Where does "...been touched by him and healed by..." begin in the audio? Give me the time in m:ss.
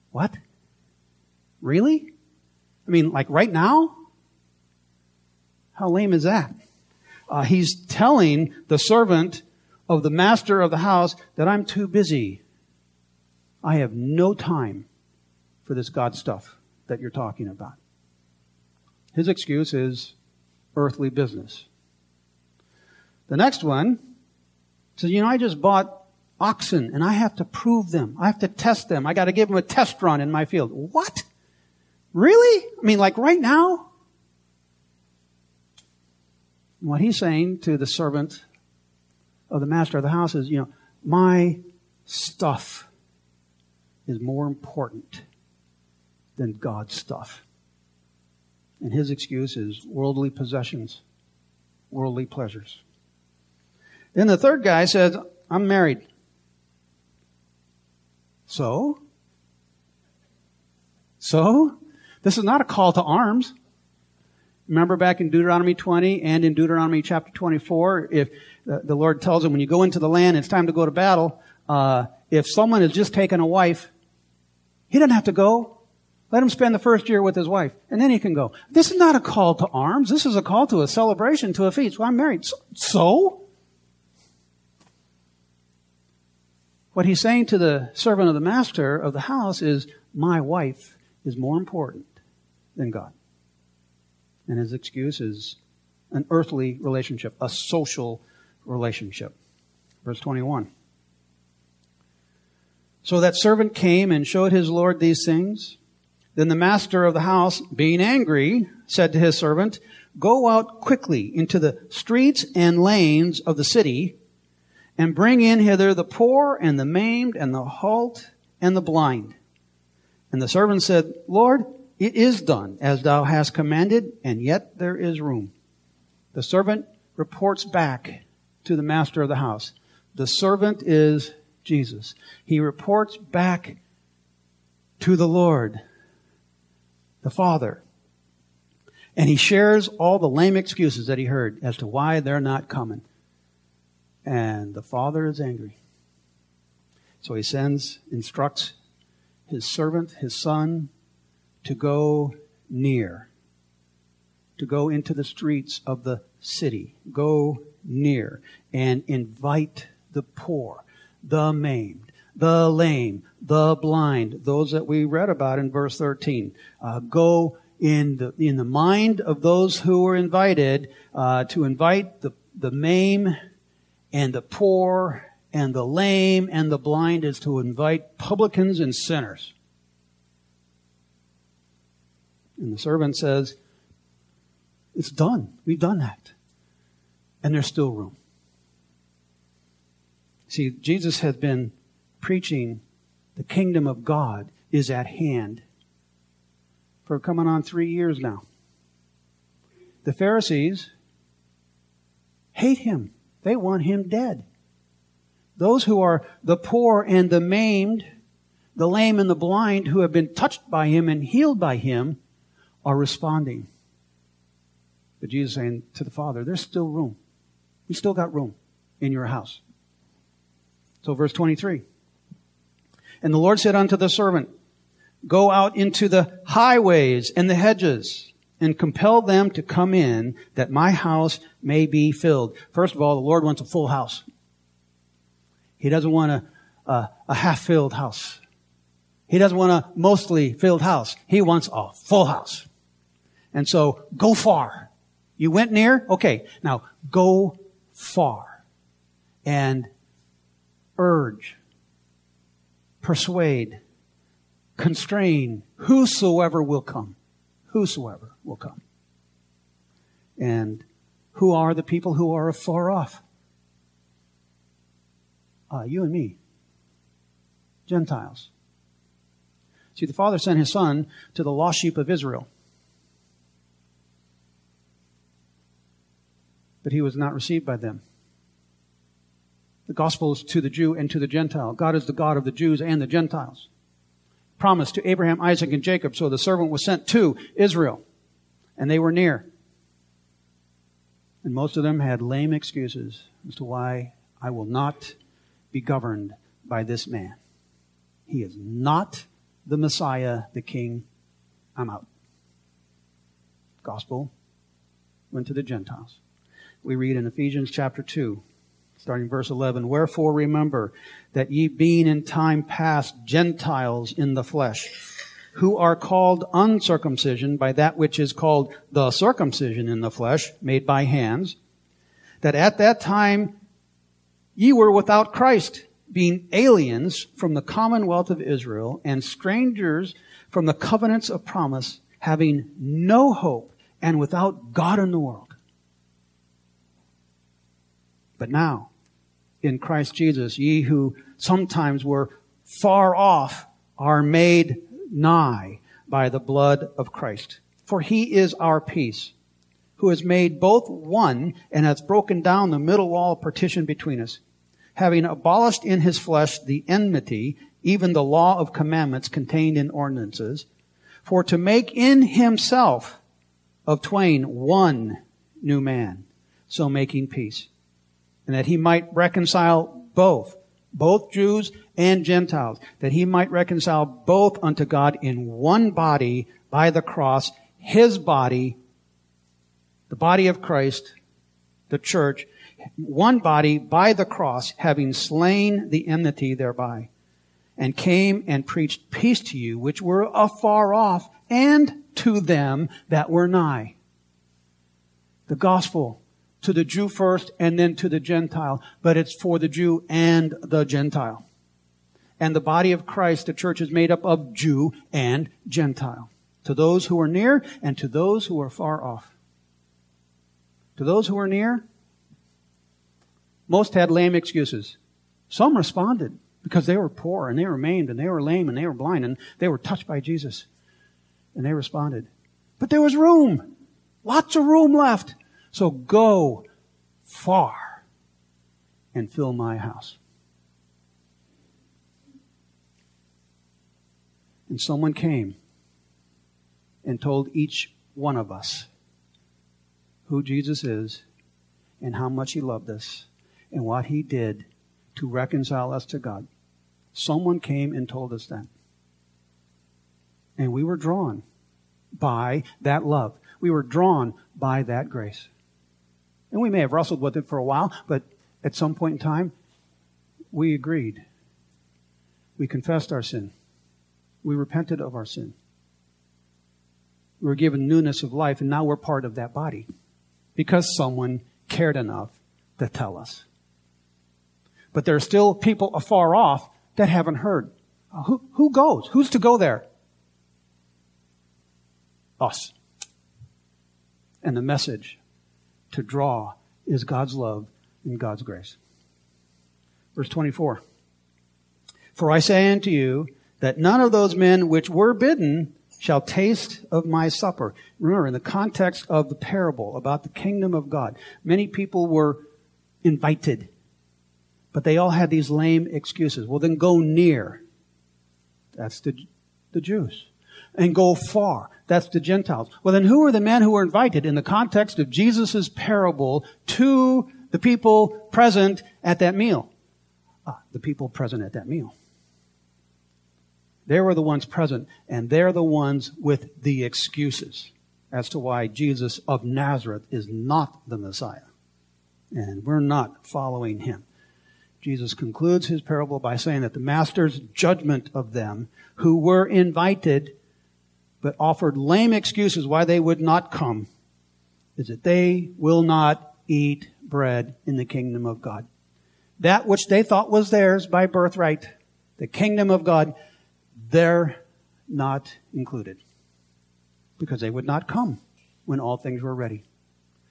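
3:30.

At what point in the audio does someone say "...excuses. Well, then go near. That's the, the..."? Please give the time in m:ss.
8:25.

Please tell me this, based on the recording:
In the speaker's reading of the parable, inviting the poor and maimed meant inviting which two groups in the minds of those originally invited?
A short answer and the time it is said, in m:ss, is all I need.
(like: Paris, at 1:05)
Publicans and sinners, at 2:58.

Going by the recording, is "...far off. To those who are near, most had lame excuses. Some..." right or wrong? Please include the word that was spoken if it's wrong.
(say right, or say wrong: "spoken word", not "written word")
right.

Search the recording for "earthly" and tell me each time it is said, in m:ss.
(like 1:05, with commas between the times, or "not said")
0:20, 1:36.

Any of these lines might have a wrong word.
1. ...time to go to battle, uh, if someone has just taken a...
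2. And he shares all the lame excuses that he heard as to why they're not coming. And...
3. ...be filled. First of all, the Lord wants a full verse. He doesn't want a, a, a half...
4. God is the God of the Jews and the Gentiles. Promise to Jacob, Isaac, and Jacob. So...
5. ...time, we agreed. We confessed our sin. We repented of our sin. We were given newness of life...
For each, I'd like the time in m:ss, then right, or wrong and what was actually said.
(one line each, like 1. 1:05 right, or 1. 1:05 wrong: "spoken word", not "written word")
1. 1:10 right
2. 2:19 right
3. 3:51 wrong: "house", not "verse"
4. 4:41 wrong: "Abraham", not "Jacob"
5. 7:39 right.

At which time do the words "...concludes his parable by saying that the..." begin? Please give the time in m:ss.
8:55.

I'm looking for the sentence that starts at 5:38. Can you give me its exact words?
But now, in Christ Jesus, ye who sometimes were far off are made nigh by the blood of Christ.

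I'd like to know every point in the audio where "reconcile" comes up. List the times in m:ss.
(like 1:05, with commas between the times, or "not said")
6:09, 6:13, 7:25.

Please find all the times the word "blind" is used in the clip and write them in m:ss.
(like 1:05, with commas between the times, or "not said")
1:58, 2:43, 2:56, 3:29, 6:58.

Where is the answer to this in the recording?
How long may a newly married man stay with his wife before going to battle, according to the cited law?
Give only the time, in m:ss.
1:16.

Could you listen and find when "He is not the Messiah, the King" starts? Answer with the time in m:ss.
4:58.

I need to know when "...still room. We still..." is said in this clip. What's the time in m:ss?
3:36.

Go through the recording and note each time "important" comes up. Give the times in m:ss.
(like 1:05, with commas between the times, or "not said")
0:44, 1:31.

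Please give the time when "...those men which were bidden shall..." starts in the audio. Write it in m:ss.
8:14.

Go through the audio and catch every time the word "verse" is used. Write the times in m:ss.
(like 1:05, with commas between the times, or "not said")
1:40, 2:45, 3:41, 5:09, 8:10.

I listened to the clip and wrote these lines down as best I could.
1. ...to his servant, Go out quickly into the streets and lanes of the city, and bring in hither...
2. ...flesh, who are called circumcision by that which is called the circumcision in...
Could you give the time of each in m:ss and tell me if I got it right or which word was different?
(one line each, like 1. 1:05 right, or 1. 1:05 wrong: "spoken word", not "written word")
1. 1:49 right
2. 5:14 wrong: "uncircumcision", not "circumcision".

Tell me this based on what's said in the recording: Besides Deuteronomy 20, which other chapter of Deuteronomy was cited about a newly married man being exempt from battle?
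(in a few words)
Chapter 24.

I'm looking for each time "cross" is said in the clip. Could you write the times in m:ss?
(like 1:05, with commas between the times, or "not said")
6:17, 6:24.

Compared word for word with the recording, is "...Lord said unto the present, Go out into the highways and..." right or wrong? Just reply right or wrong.
wrong.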